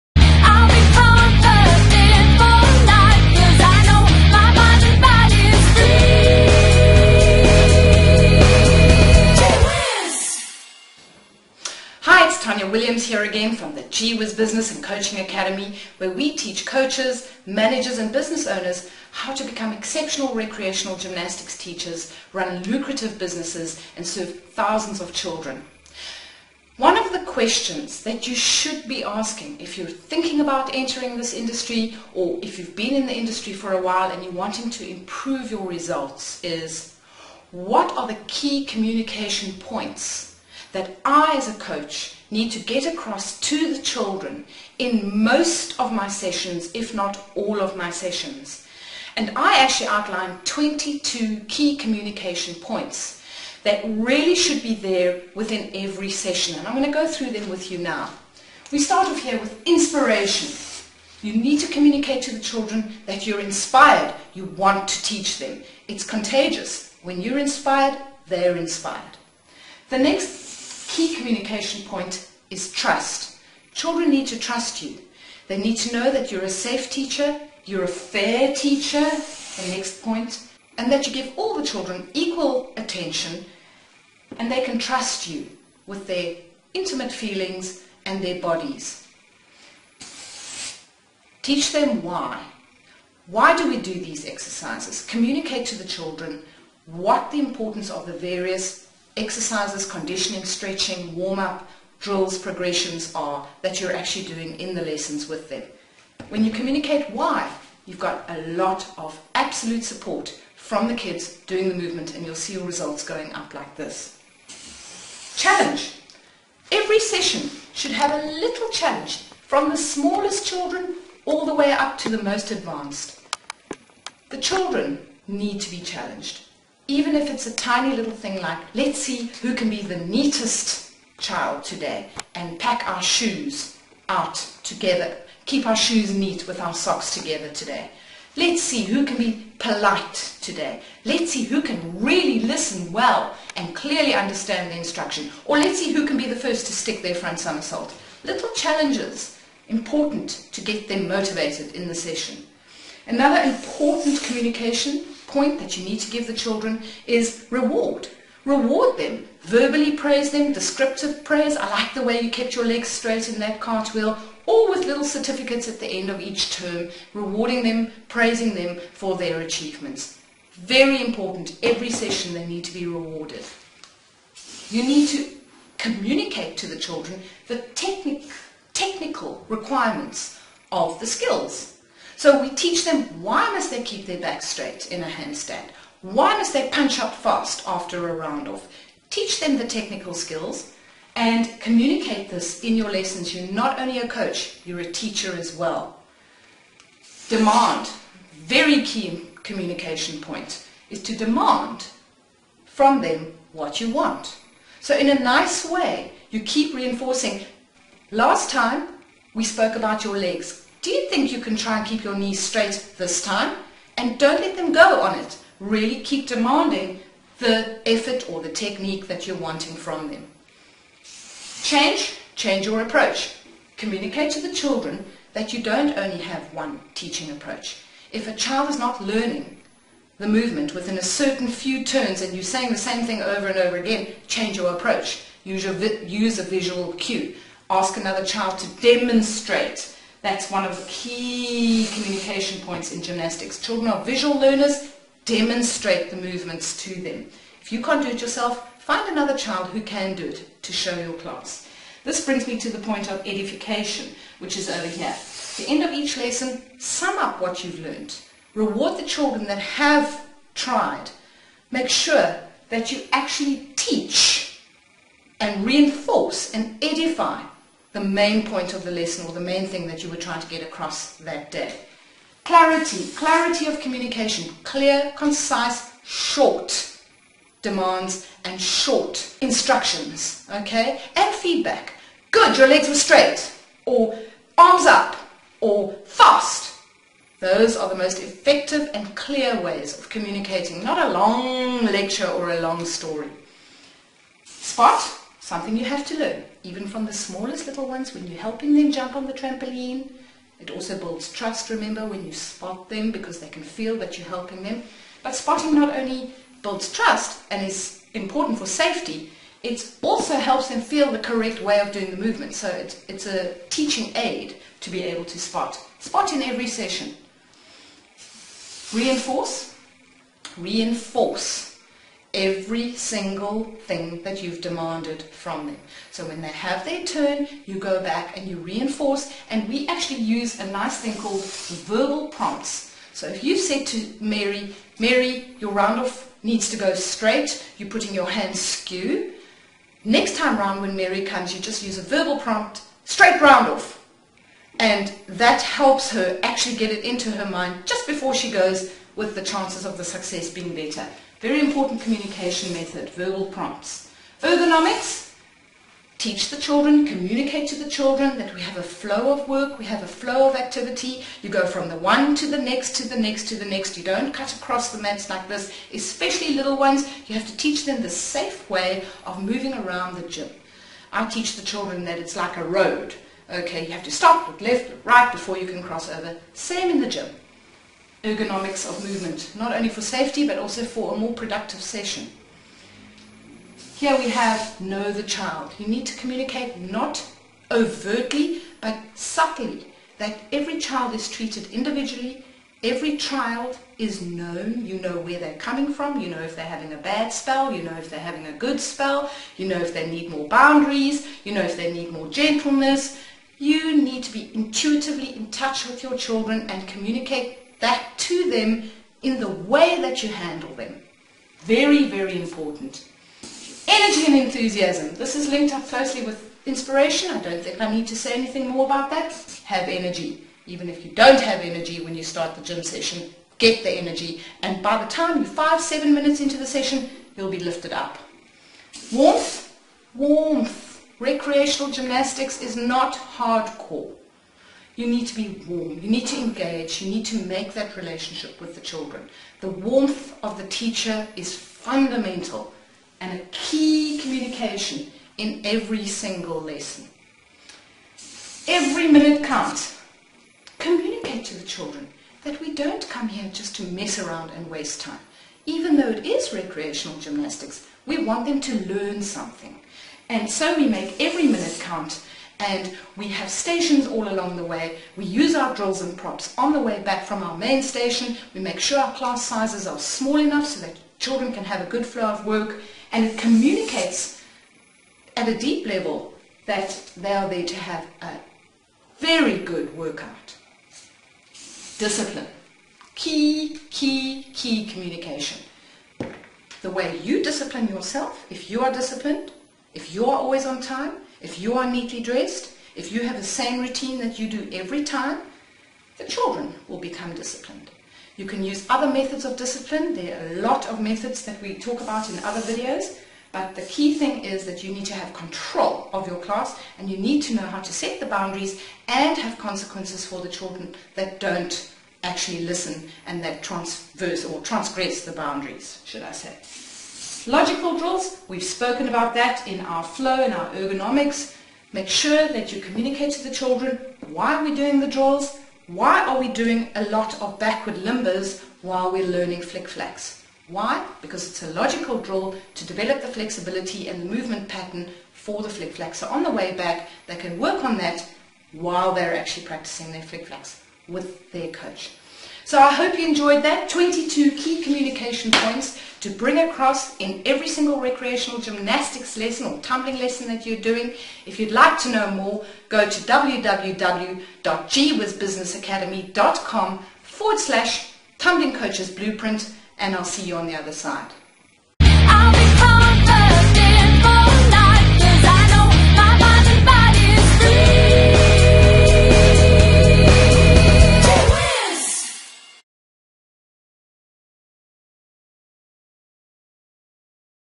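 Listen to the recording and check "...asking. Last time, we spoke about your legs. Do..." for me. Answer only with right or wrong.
wrong.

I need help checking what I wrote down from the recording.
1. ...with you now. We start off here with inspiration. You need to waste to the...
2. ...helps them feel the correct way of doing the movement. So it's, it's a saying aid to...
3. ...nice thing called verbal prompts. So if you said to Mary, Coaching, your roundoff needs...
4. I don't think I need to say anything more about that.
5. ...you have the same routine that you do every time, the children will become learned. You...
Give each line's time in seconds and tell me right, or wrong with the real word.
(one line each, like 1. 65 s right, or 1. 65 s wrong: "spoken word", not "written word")
1. 57 s wrong: "communicate", not "waste"
2. 310 s wrong: "teaching", not "saying"
3. 330 s wrong: "Mary", not "Coaching"
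4. 417 s right
5. 493 s wrong: "disciplined", not "learned".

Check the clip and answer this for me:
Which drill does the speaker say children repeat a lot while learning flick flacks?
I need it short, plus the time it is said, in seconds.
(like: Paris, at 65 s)
Backward limbers, at 527 s.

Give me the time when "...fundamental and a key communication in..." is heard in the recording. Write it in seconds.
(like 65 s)
441 s.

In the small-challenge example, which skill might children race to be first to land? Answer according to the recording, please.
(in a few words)
Front somersault.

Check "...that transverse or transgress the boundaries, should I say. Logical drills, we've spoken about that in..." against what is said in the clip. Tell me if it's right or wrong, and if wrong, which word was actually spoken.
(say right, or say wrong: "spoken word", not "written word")
right.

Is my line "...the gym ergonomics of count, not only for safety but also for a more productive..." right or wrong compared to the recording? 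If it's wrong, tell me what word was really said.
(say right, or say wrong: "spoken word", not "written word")
wrong: "movement", not "count".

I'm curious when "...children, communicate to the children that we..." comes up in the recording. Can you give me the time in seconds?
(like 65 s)
356 s.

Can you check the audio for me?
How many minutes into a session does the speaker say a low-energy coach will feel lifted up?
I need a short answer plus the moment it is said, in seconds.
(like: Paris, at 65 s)
five, seven minutes, at 425 s.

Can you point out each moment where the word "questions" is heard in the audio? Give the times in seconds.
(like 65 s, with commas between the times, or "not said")
27 s.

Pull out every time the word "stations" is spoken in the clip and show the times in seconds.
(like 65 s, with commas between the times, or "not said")
463 s, 467 s.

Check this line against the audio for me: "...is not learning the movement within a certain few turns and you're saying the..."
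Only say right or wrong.
right.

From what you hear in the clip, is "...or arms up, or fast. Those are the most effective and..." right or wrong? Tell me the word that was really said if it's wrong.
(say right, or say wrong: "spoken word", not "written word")
right.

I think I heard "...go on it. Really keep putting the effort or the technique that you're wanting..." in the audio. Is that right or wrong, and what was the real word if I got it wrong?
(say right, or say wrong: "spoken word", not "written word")
wrong: "demanding", not "putting".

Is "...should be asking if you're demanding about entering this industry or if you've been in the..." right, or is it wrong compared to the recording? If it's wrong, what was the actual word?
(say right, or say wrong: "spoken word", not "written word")
wrong: "thinking", not "demanding".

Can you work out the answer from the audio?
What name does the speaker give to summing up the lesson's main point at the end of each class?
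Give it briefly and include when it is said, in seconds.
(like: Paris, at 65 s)
Edification, at 253 s.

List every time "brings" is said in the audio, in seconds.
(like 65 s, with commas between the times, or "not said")
252 s, 546 s.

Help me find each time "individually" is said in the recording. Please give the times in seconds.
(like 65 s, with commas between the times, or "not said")
391 s.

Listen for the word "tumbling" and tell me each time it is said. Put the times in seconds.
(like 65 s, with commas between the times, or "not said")
549 s, 558 s.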